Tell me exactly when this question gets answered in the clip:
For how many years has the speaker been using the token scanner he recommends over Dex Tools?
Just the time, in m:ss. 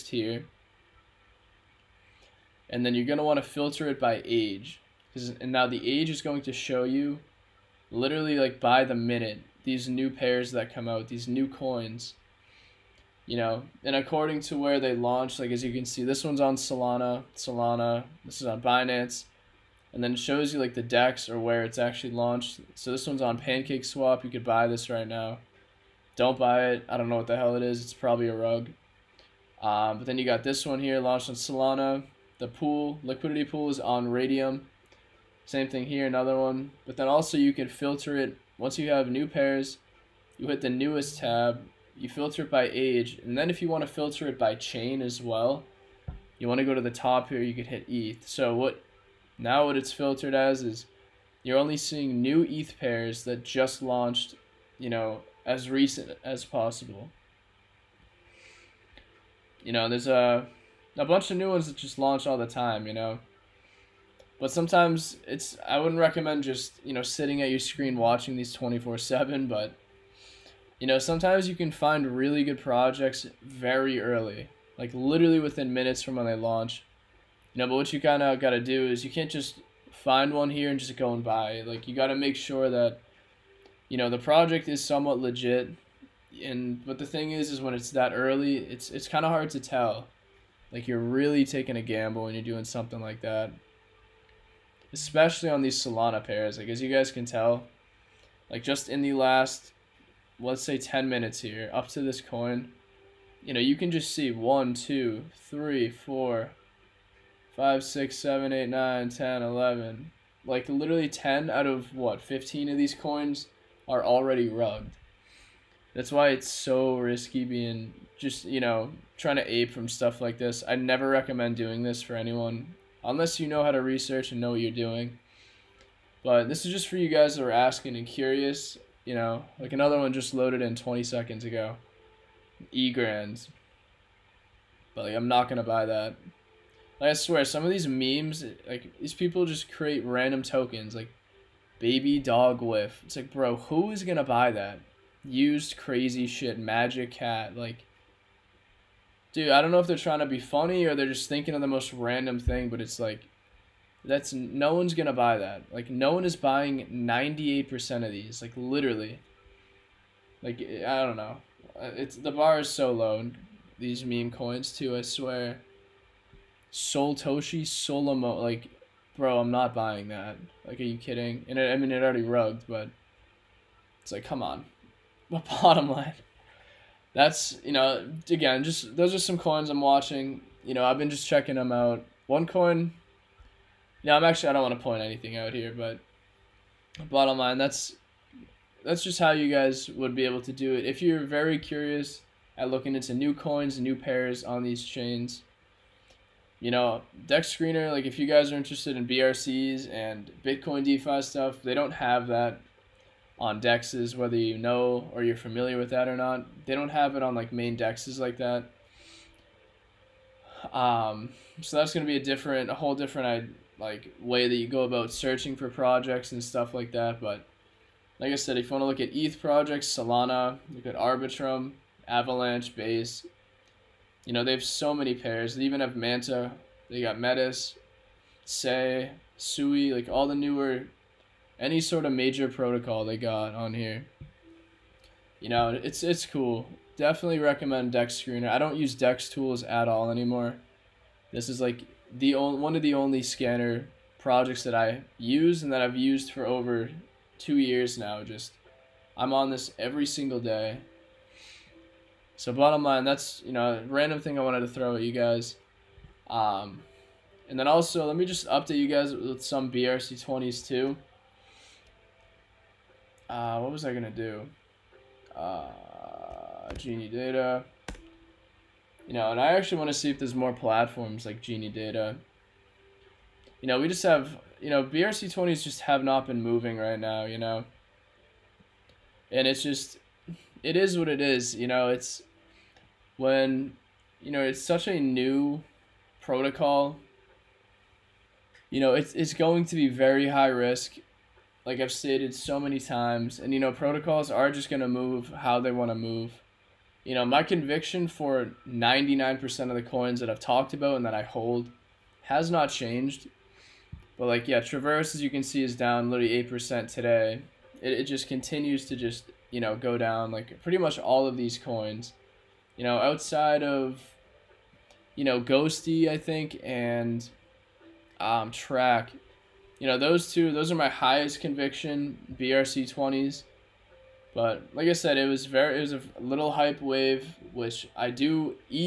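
4:07.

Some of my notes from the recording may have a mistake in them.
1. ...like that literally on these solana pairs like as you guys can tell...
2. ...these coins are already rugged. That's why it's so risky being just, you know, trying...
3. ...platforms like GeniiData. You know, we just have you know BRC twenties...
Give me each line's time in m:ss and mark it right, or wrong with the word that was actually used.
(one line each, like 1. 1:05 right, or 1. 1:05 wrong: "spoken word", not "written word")
1. 1:32 wrong: "especially", not "literally"
2. 1:52 right
3. 4:30 right.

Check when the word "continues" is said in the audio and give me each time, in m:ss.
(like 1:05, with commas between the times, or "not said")
5:08.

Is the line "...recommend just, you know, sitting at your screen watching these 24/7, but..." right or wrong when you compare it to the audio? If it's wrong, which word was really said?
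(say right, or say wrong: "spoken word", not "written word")
right.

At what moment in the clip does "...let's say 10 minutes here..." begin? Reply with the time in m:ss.
1:40.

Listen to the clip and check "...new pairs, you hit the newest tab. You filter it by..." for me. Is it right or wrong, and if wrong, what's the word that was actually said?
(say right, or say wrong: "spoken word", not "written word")
right.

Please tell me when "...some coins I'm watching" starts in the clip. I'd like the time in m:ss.
2:59.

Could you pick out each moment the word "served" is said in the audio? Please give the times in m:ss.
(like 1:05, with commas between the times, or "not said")
not said.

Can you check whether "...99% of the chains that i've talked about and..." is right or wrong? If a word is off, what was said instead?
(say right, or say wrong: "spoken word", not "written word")
wrong: "coins", not "chains".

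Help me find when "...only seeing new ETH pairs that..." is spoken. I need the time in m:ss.
0:51.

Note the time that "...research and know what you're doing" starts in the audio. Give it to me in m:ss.
2:03.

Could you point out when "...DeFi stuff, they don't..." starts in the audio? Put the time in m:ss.
3:20.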